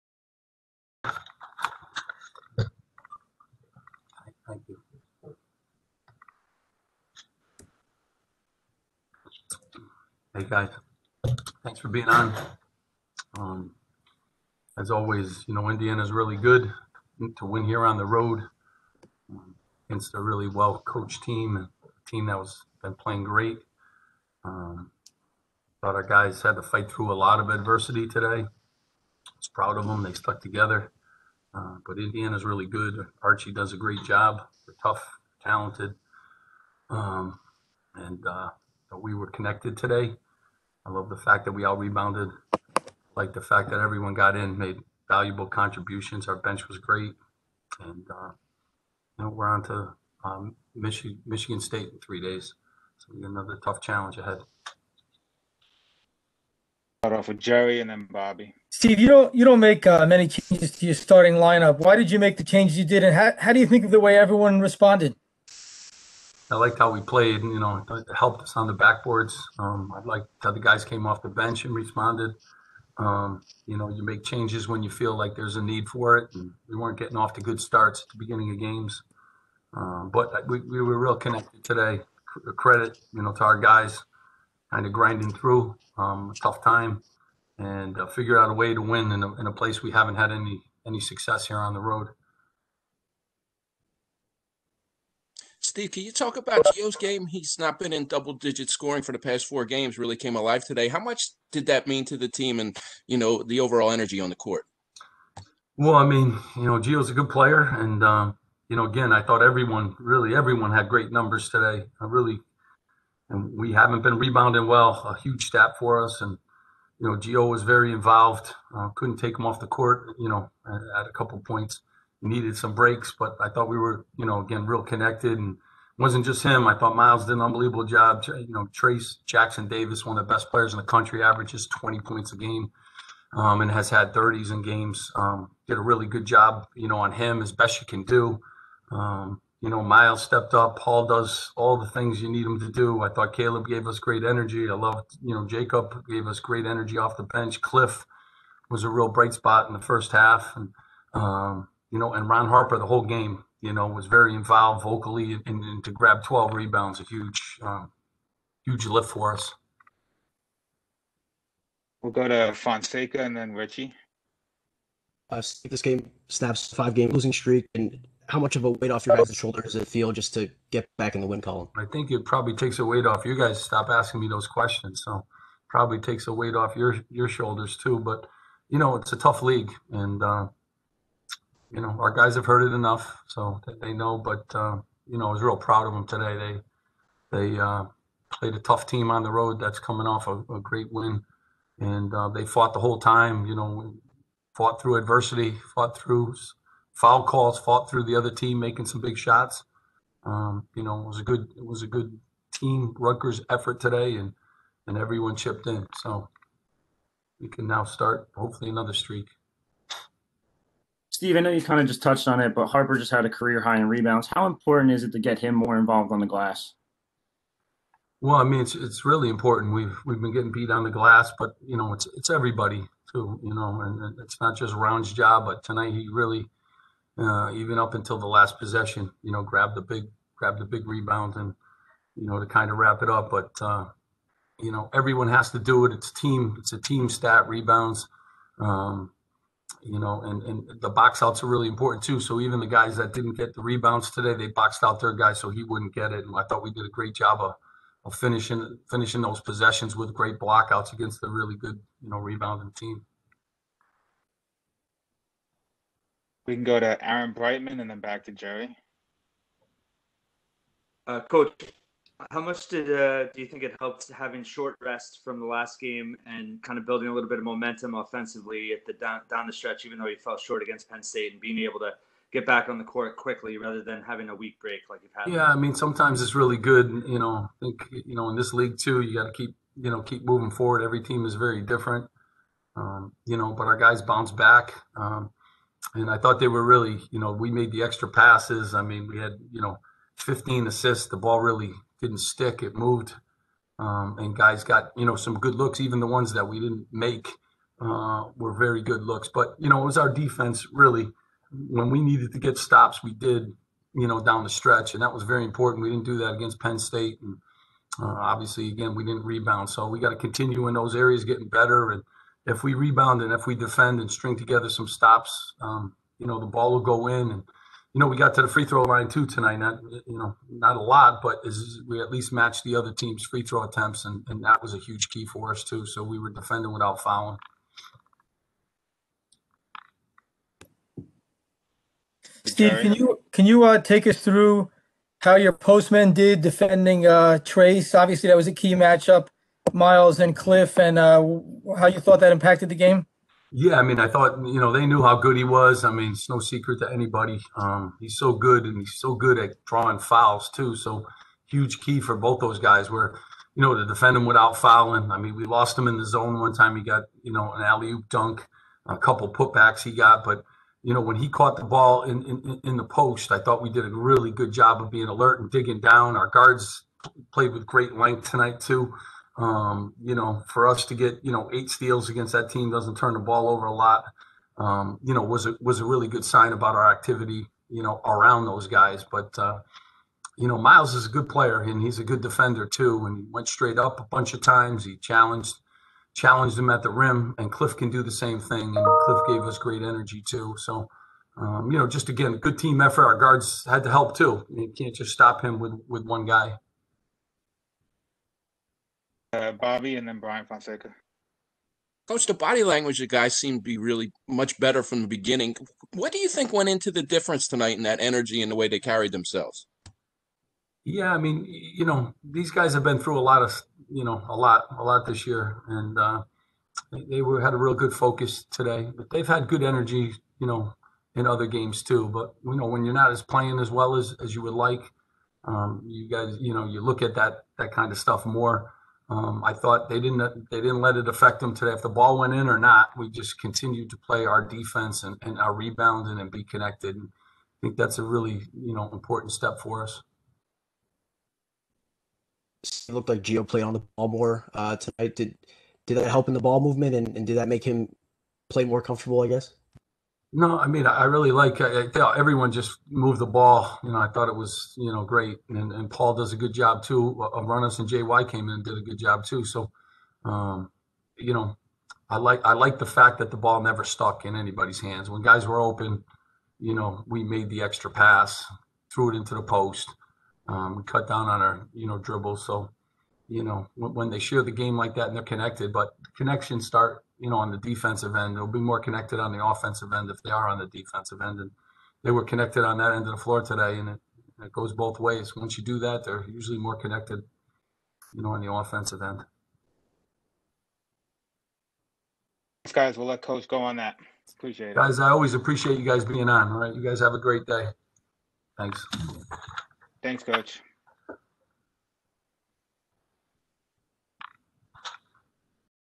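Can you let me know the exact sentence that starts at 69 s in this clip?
Um, I liked how the guys came off the bench and responded.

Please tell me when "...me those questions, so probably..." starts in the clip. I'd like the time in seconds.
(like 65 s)
174 s.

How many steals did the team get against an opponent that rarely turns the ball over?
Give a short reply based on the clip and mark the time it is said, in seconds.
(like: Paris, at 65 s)
8, at 371 s.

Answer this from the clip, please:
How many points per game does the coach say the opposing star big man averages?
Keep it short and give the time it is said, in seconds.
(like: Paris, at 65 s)
20, at 131 s.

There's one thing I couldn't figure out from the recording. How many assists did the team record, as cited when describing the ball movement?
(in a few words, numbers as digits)
15.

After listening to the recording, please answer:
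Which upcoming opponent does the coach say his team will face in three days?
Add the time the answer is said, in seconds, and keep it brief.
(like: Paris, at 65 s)
Michigan State, at 51 s.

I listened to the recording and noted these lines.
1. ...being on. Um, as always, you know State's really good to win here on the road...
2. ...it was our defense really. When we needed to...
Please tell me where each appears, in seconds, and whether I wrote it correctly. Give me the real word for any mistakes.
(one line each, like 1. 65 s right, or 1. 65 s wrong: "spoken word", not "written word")
1. 11 s wrong: "Indiana", not "State"
2. 299 s right.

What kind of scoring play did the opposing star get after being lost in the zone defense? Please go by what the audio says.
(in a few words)
alley oop dunk.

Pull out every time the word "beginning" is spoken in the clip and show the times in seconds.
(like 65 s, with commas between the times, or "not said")
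78 s, 405 s.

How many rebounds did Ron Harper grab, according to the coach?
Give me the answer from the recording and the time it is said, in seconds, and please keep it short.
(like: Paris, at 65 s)
12, at 156 s.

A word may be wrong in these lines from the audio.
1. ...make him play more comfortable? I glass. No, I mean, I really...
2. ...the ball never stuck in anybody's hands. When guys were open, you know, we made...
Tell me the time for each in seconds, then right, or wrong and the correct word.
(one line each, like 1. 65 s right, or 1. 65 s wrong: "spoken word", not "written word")
1. 447 s wrong: "guess", not "glass"
2. 463 s right.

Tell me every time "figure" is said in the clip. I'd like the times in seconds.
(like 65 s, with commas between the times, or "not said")
88 s.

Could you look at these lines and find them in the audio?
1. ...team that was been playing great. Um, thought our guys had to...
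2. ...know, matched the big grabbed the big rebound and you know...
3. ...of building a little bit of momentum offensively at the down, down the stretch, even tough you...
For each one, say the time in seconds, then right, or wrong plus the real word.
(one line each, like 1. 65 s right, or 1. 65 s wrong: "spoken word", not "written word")
1. 22 s right
2. 229 s wrong: "grabbed", not "matched"
3. 266 s wrong: "though", not "tough".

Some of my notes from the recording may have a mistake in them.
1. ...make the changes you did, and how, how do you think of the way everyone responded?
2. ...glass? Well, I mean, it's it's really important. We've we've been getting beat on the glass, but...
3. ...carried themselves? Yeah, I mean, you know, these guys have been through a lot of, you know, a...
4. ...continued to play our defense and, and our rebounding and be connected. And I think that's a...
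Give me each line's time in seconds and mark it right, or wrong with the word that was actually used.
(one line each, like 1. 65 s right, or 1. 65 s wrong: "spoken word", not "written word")
1. 62 s right
2. 216 s right
3. 408 s right
4. 433 s right.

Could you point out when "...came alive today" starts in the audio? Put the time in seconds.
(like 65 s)
100 s.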